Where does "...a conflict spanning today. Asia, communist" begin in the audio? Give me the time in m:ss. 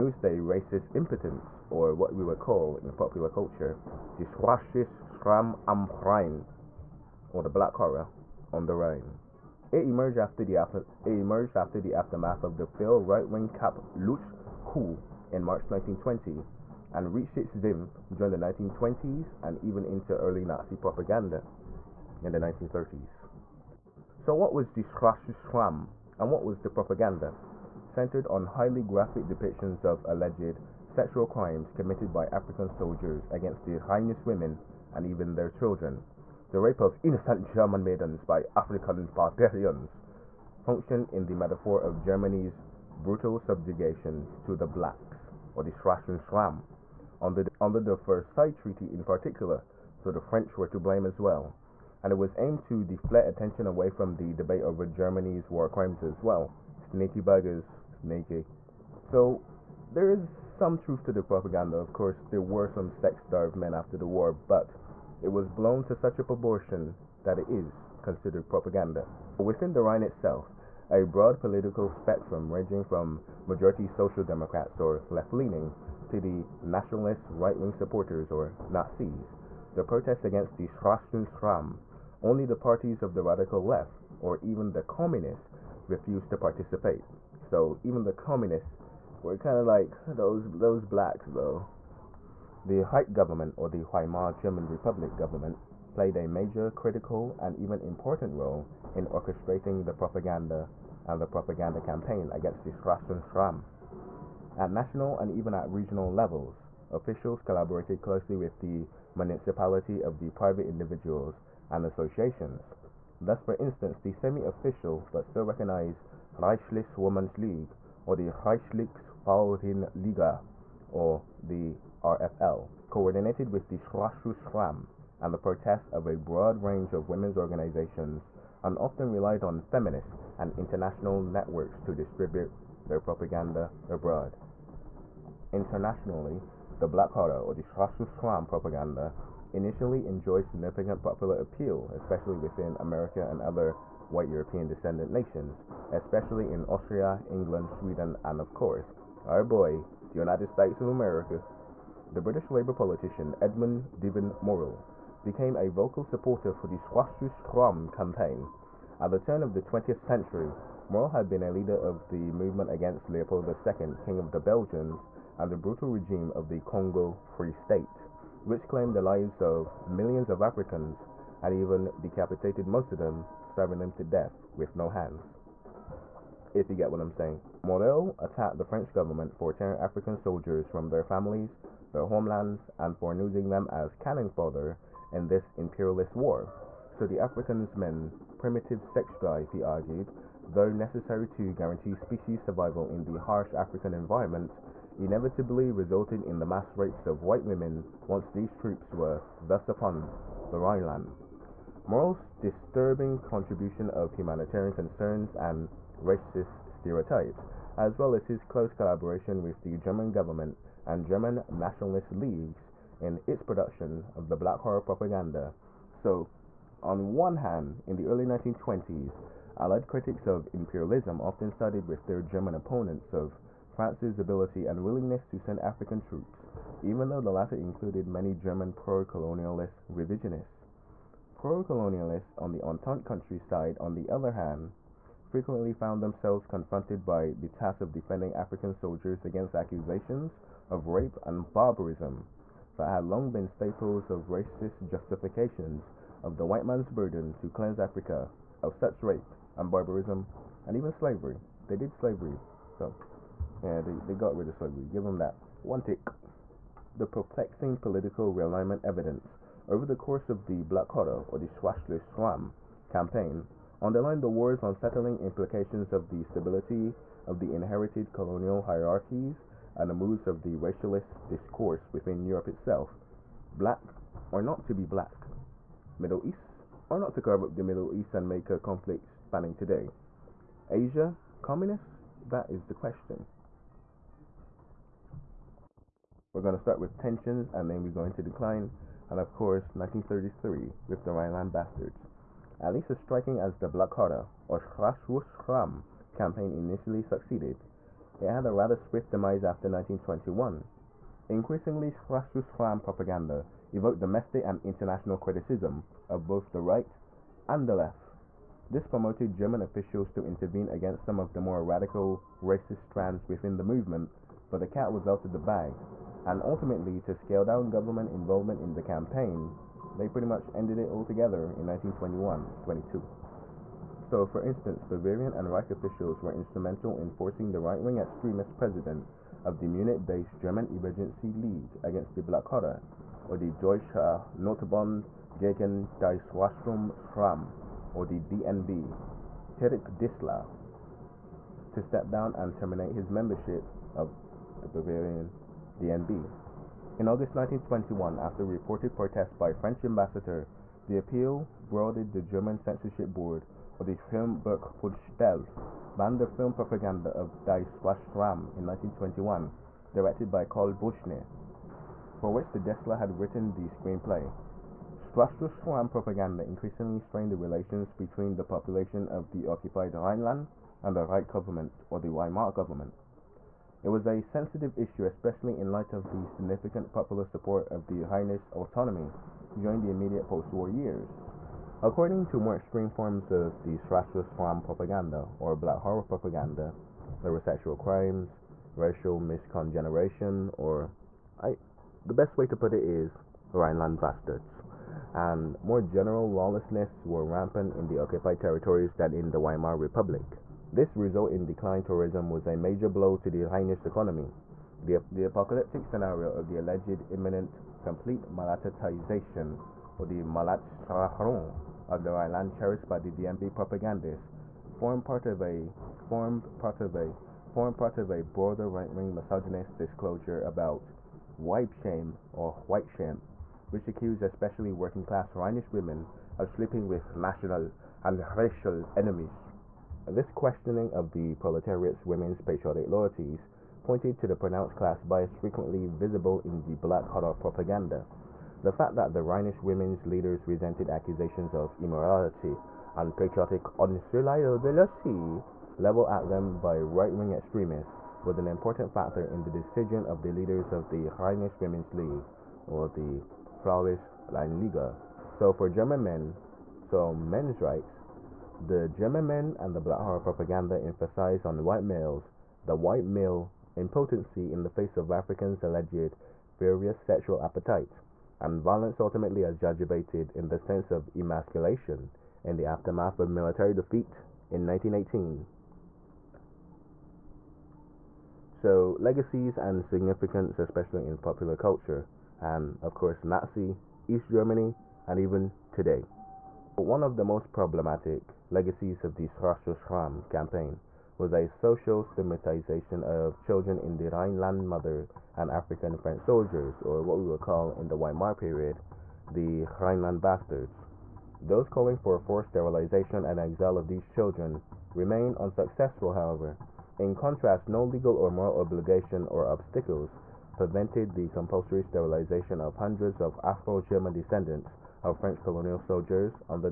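4:38.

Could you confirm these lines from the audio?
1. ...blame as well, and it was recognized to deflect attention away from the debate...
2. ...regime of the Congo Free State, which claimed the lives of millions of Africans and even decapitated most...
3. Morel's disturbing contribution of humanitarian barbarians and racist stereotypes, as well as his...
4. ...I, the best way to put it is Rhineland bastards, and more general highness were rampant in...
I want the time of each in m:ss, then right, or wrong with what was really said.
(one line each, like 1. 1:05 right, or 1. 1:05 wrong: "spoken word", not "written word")
1. 0:50 wrong: "aimed", not "recognized"
2. 2:45 right
3. 3:21 wrong: "concerns", not "barbarians"
4. 6:31 wrong: "lawlessness", not "highness".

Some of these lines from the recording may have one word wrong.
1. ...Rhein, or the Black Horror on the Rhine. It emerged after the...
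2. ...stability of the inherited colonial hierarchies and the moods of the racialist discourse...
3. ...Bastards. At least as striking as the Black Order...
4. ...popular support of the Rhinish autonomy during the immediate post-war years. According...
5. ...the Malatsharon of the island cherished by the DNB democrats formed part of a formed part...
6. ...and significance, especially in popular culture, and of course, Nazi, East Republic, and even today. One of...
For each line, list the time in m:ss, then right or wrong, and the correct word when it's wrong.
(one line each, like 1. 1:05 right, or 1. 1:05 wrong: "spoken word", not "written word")
1. 0:06 right
2. 4:26 right
3. 4:51 right
4. 6:16 right
5. 6:50 wrong: "propagandists", not "democrats"
6. 7:59 wrong: "Germany", not "Republic".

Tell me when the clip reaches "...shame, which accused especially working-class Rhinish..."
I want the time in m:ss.
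7:02.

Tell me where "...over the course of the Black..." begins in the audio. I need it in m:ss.
4:19.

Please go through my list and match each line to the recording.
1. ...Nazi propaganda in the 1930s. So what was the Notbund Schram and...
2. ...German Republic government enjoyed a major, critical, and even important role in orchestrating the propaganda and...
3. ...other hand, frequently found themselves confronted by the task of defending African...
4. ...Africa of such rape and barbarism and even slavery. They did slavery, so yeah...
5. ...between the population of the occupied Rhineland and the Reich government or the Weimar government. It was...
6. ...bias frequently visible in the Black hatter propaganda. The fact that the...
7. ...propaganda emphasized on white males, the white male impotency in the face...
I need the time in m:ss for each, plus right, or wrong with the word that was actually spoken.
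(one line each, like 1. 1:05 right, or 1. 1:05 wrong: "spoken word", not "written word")
1. 0:20 wrong: "Schwarzes", not "Notbund"
2. 1:34 wrong: "played", not "enjoyed"
3. 3:54 right
4. 4:07 right
5. 6:07 right
6. 7:15 right
7. 7:40 right.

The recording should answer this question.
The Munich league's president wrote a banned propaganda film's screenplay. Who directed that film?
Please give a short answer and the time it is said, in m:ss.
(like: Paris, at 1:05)
Karl Buschner, at 6:00.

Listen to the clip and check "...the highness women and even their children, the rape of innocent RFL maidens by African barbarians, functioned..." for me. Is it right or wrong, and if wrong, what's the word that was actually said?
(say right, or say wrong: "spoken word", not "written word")
wrong: "German", not "RFL".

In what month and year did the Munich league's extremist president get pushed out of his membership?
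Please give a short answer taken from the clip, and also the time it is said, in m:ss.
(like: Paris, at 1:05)
August 1921, at 5:47.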